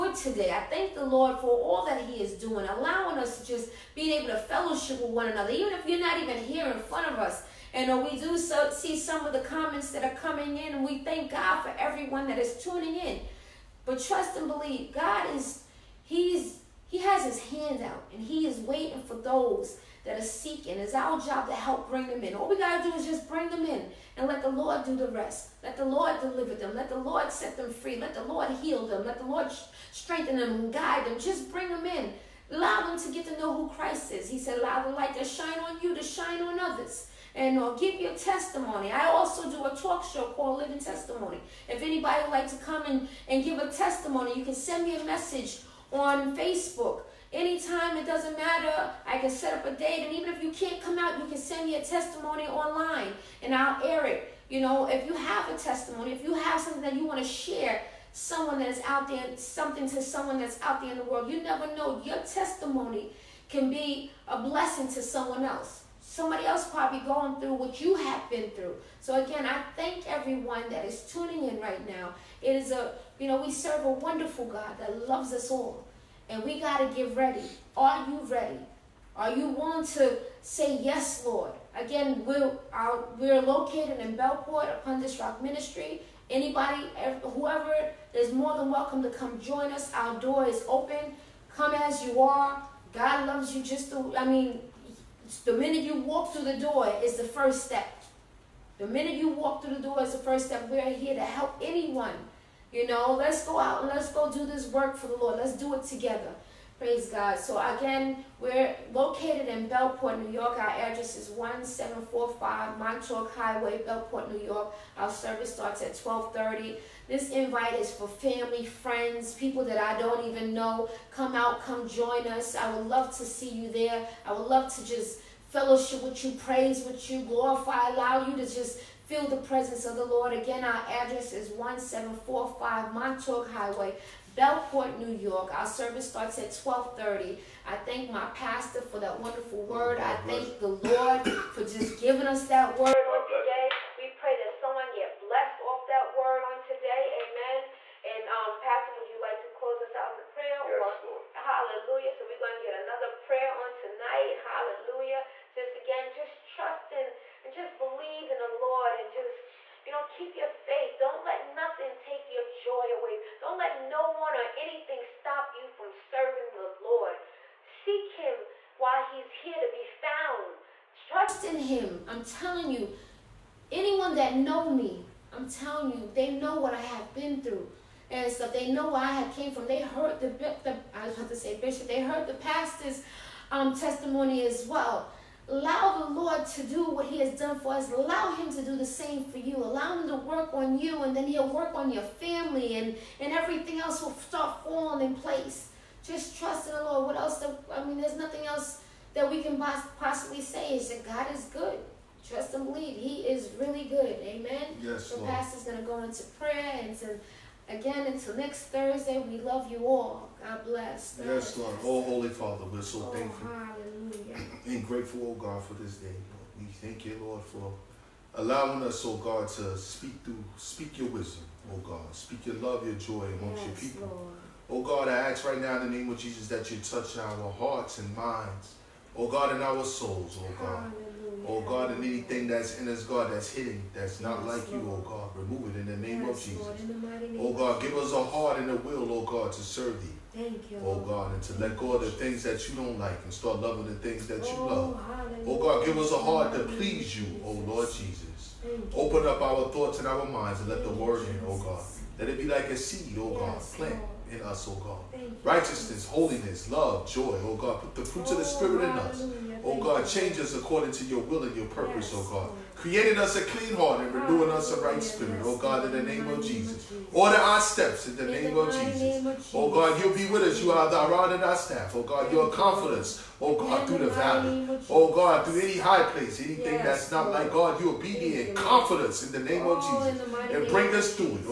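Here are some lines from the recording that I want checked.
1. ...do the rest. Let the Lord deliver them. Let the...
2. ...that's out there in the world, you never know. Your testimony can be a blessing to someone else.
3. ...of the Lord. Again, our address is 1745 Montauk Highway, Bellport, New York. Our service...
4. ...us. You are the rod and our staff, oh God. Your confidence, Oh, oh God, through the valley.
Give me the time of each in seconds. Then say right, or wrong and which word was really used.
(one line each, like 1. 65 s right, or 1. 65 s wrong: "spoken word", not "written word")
1. 24 s right
2. 60 s right
3. 129 s right
4. 270 s right.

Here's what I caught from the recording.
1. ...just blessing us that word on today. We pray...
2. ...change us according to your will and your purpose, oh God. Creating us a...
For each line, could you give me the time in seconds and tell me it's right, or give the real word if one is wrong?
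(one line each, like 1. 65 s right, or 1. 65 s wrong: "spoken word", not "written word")
1. 141 s wrong: "giving", not "blessing"
2. 260 s right.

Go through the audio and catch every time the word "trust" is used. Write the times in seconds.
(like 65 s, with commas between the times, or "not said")
14 s, 156 s, 171 s, 196 s, 202 s.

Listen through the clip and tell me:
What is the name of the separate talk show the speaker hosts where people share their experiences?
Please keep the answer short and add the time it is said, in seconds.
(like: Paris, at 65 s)
Living Testimony, at 40 s.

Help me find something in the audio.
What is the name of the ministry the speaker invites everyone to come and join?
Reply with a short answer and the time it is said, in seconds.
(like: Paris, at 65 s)
Upon This Rock Ministry, at 84 s.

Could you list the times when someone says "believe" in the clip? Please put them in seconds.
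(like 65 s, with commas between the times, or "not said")
14 s, 157 s, 202 s.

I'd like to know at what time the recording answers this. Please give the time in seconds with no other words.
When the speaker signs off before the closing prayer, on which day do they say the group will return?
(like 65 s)
208 s.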